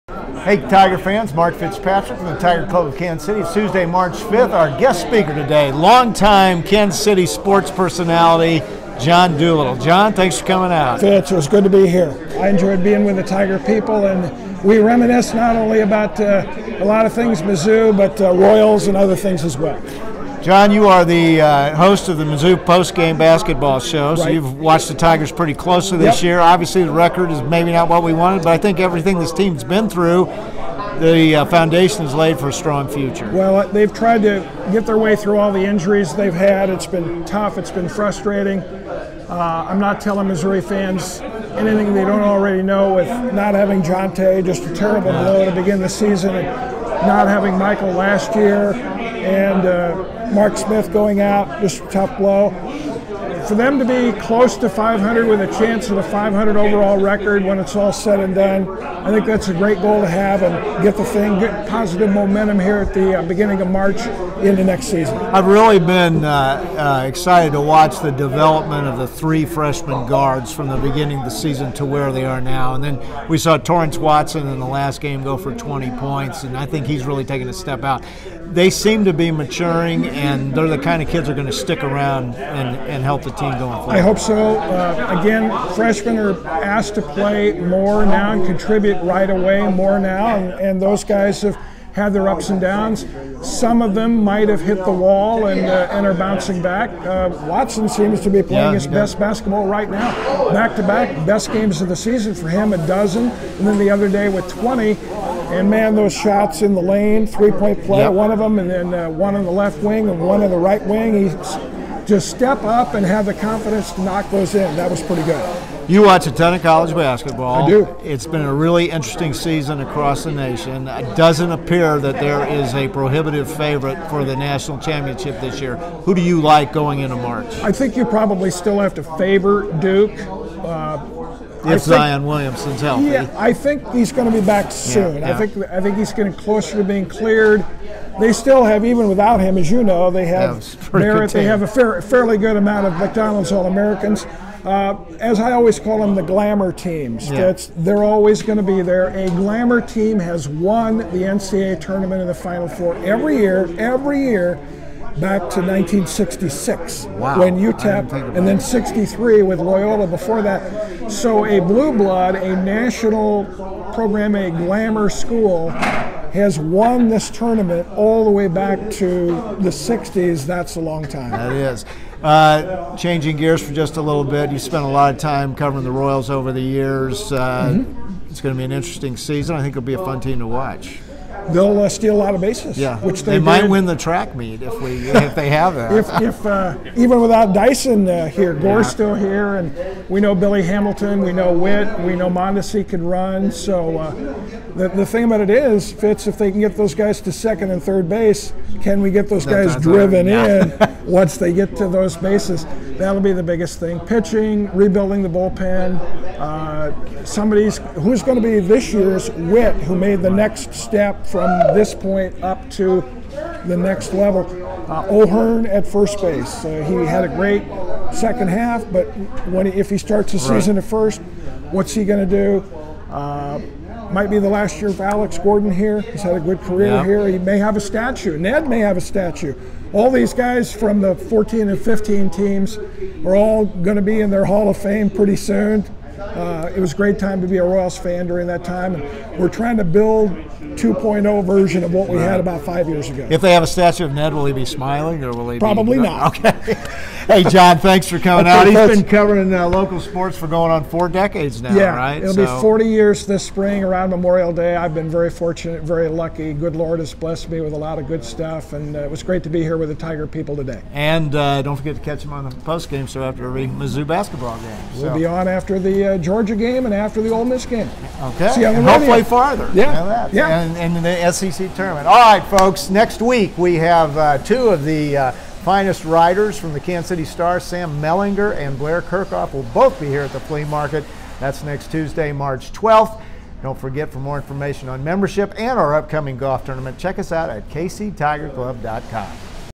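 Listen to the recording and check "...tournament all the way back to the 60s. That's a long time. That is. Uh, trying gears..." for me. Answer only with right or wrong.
wrong.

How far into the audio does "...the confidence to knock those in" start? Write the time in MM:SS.
01:53.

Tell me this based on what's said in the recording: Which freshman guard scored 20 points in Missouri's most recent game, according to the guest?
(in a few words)
Torrence Watson.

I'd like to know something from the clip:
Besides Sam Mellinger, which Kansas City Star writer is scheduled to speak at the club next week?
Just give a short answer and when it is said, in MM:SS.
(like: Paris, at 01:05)
Blair Kerkhoff, at 04:38.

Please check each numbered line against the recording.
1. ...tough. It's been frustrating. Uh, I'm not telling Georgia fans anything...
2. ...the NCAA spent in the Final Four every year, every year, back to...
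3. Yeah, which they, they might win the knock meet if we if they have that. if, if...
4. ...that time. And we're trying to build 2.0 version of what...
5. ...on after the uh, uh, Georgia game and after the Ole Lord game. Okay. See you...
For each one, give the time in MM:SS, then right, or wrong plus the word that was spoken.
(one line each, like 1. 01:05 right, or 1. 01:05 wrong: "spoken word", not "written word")
1. 00:37 wrong: "Missouri", not "Georgia"
2. 02:30 wrong: "tournament", not "spent"
3. 03:02 wrong: "track", not "knock"
4. 03:58 right
5. 04:25 wrong: "Miss", not "Lord".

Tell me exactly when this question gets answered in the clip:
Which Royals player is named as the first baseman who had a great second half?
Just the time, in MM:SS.
03:35.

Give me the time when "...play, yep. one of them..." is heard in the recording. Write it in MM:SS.
01:47.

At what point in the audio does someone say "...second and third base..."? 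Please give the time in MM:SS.
03:17.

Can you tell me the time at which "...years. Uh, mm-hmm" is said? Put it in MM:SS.
02:56.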